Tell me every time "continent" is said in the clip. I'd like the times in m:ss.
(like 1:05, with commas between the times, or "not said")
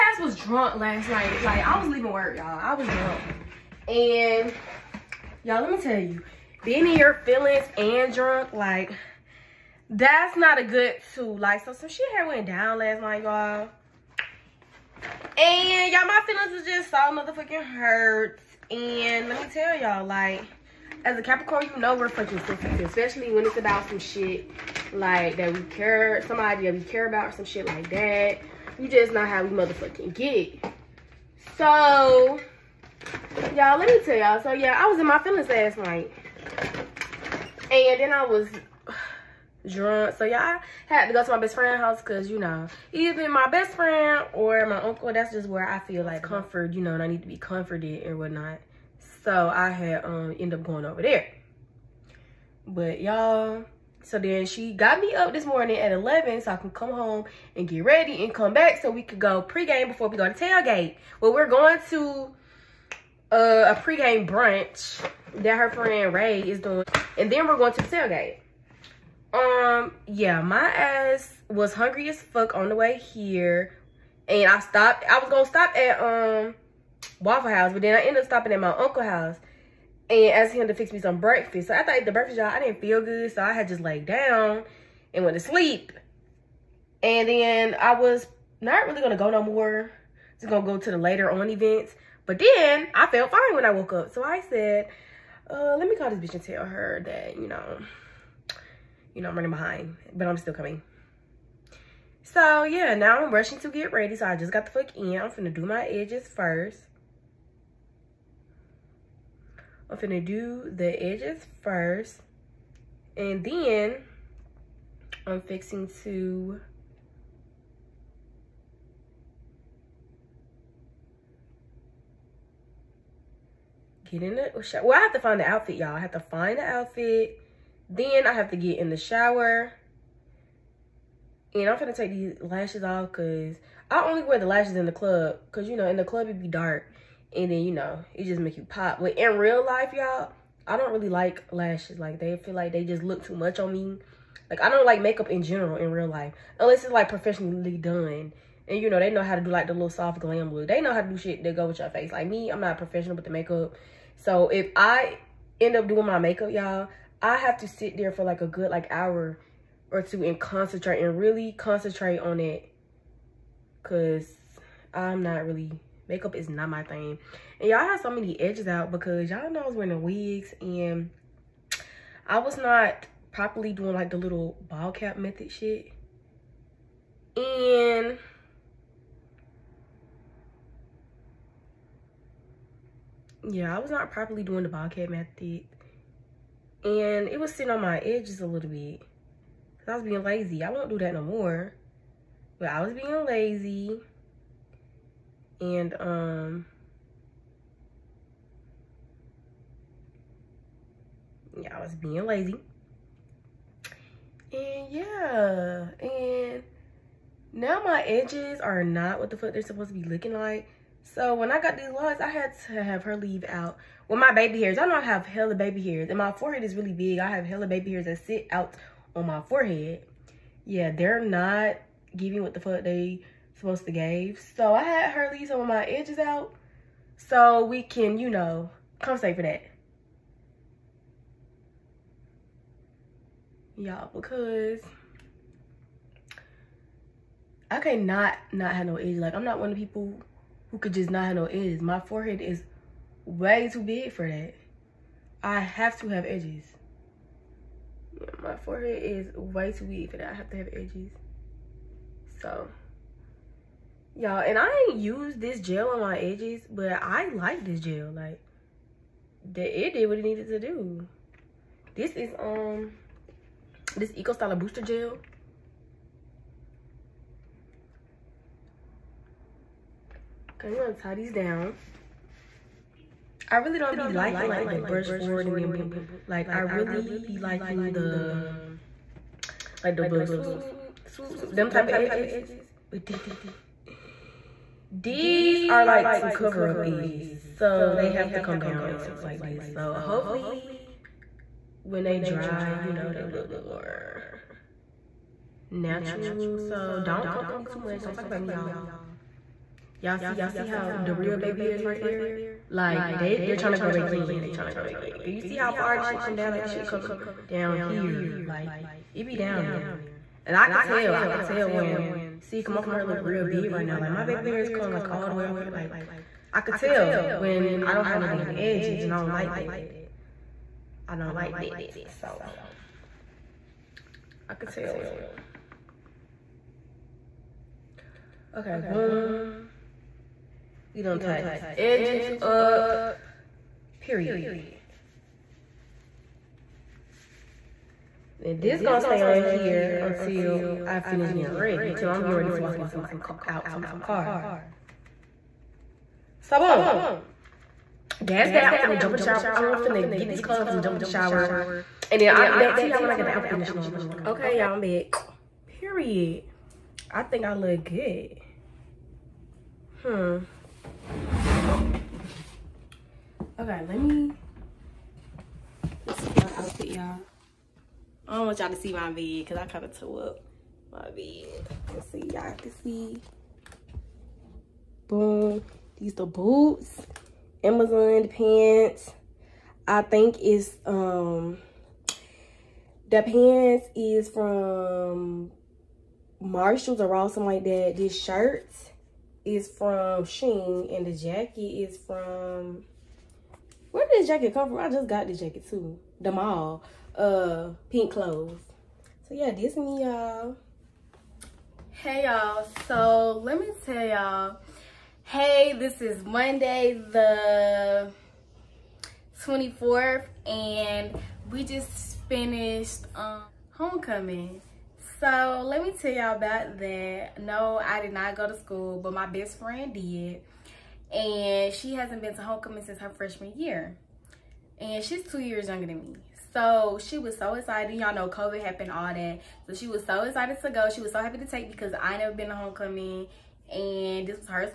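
not said.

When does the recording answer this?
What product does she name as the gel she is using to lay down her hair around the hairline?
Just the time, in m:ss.
4:24.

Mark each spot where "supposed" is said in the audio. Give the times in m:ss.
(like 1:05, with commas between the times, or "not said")
3:29, 3:43.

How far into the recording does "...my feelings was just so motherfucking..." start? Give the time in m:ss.
0:16.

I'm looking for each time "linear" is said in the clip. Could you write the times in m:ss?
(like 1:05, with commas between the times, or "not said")
not said.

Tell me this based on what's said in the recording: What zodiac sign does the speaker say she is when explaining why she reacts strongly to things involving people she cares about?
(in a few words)
Capricorn.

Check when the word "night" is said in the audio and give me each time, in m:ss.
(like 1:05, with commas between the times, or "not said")
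0:01, 0:13, 0:35.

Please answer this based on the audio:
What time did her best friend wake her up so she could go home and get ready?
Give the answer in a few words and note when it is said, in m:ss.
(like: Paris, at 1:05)
11, at 0:55.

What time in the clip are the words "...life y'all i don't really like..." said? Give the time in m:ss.
2:19.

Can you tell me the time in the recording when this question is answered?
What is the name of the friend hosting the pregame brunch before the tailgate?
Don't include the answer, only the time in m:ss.
1:06.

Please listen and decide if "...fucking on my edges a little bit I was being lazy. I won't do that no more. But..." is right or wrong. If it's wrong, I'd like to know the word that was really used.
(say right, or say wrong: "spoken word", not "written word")
wrong: "sitting", not "fucking".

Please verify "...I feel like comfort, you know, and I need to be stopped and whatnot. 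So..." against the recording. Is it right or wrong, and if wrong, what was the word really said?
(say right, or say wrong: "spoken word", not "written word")
wrong: "comforted", not "stopped".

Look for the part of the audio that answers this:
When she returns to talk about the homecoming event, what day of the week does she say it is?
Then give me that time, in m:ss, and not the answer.
6:46.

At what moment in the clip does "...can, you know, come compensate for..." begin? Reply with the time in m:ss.
3:47.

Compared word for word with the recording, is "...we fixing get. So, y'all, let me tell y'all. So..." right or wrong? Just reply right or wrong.
wrong.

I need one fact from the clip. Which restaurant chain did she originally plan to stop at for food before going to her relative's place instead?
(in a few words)
Waffle House.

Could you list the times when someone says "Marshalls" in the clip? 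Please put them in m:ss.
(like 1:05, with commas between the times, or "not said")
6:26.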